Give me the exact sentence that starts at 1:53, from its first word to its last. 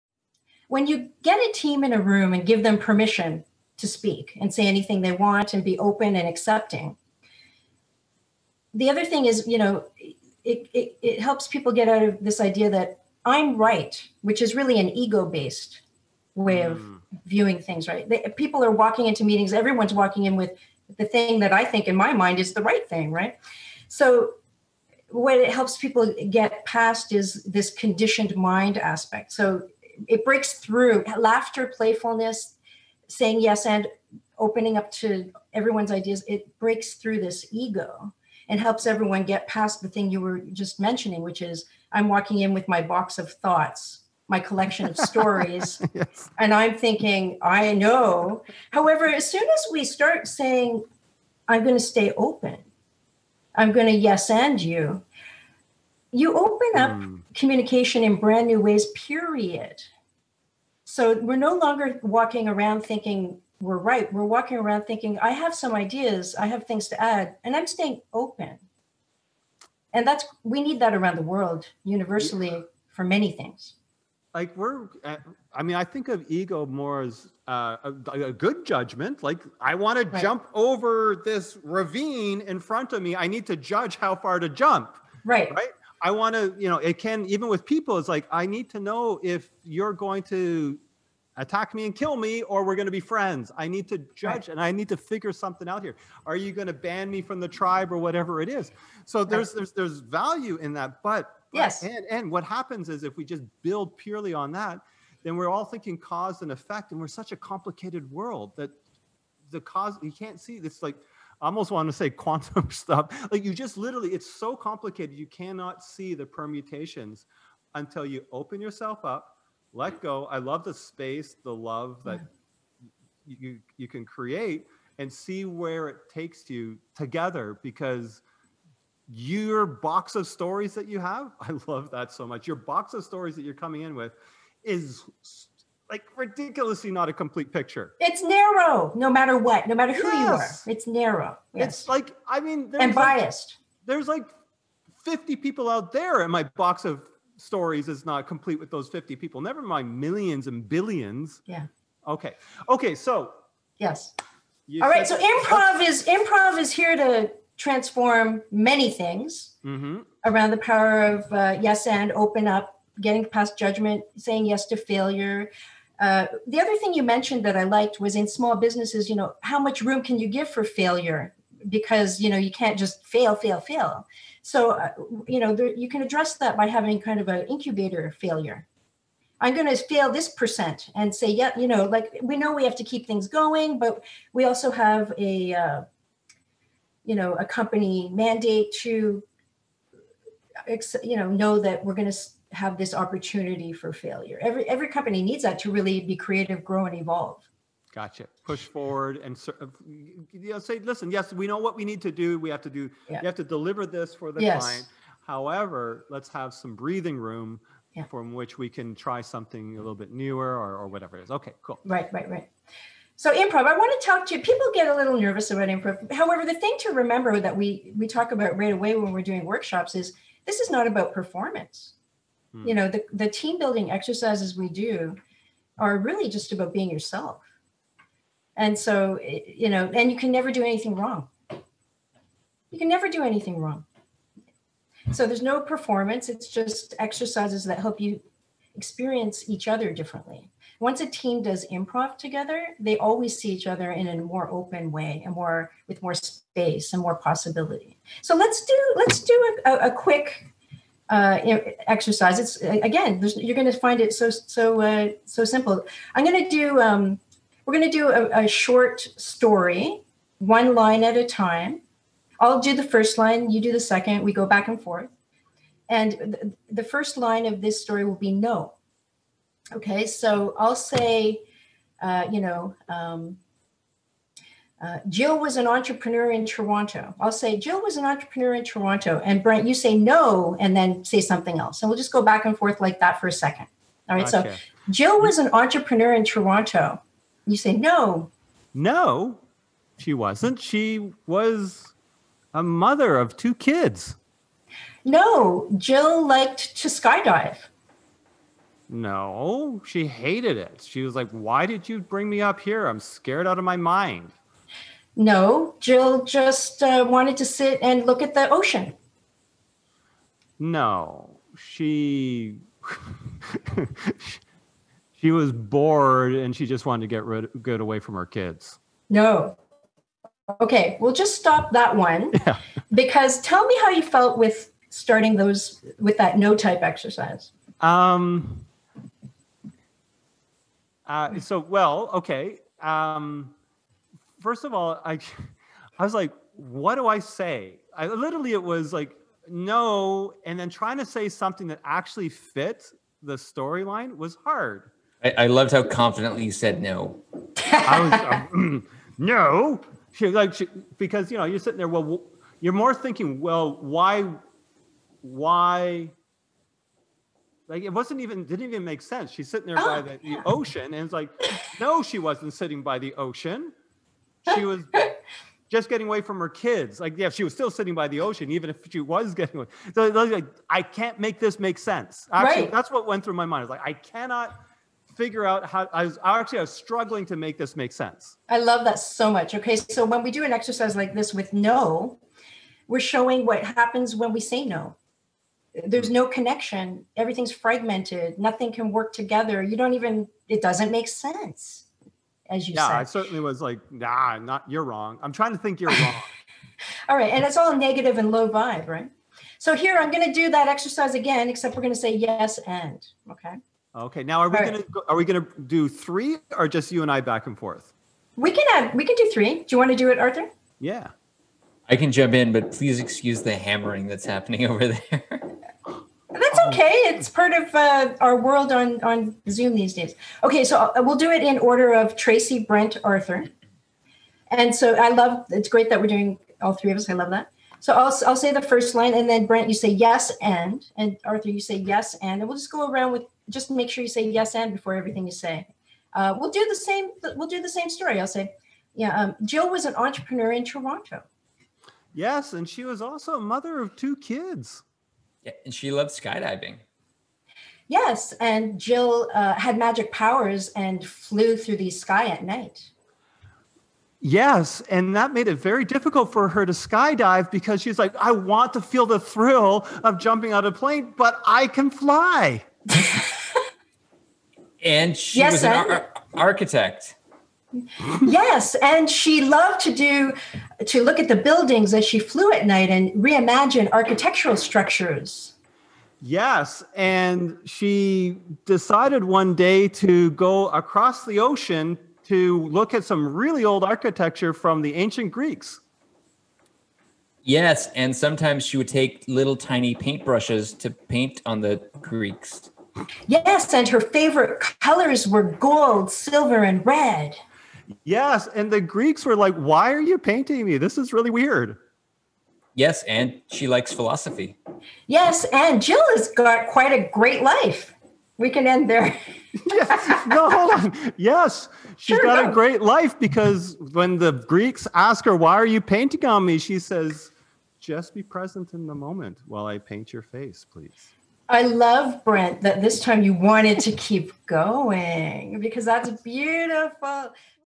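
Like you just literally, it's so complicated.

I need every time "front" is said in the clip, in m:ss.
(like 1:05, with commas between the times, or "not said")
1:22.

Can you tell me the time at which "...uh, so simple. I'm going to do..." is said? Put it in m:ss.
4:14.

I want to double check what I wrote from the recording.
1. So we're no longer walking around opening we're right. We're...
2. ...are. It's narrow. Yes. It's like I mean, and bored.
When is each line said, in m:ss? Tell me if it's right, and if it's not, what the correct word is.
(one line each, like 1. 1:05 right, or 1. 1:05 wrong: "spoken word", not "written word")
1. 1:00 wrong: "thinking", not "opening"
2. 2:20 wrong: "biased", not "bored".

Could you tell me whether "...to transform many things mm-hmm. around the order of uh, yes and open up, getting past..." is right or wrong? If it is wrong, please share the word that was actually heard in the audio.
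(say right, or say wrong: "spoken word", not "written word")
wrong: "power", not "order".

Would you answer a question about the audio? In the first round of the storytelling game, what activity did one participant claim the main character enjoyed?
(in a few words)
Skydiving.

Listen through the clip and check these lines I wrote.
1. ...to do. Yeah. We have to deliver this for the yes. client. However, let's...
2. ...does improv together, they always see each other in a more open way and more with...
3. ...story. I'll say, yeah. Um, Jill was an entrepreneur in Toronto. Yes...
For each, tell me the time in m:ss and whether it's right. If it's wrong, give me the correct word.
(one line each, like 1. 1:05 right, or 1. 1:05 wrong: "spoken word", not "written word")
1. 3:22 right
2. 4:01 right
3. 7:17 right.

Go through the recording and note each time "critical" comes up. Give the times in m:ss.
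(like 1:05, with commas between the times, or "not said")
not said.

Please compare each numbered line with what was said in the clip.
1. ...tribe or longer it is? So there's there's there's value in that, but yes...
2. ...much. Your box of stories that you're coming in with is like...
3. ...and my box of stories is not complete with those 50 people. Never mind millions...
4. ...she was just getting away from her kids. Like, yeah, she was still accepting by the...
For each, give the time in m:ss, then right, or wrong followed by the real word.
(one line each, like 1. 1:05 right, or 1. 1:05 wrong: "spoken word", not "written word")
1. 1:37 wrong: "whatever", not "longer"
2. 2:12 right
3. 2:26 right
4. 6:04 wrong: "sitting", not "accepting".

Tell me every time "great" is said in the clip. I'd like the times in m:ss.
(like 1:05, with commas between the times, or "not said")
7:05, 8:27, 8:32.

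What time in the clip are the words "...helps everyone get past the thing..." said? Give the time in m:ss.
0:38.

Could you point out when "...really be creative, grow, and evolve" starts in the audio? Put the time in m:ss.
3:15.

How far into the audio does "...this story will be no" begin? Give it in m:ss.
4:27.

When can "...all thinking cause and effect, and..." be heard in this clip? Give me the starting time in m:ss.
1:45.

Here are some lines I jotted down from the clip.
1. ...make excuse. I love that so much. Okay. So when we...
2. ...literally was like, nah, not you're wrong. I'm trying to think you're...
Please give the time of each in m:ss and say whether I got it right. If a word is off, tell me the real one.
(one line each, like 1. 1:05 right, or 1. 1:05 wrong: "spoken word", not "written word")
1. 6:17 wrong: "sense", not "excuse"
2. 6:33 wrong: "certainly", not "literally".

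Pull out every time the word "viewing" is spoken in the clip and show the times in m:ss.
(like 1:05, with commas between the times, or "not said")
0:17.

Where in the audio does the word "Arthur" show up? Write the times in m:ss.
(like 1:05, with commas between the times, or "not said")
6:50, 7:03, 7:11.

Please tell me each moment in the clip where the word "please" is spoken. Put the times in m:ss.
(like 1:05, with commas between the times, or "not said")
6:52, 8:40.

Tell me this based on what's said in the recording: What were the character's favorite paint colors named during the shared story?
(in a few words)
Gold, silver, and red.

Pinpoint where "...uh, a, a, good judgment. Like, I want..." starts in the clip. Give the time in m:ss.
1:17.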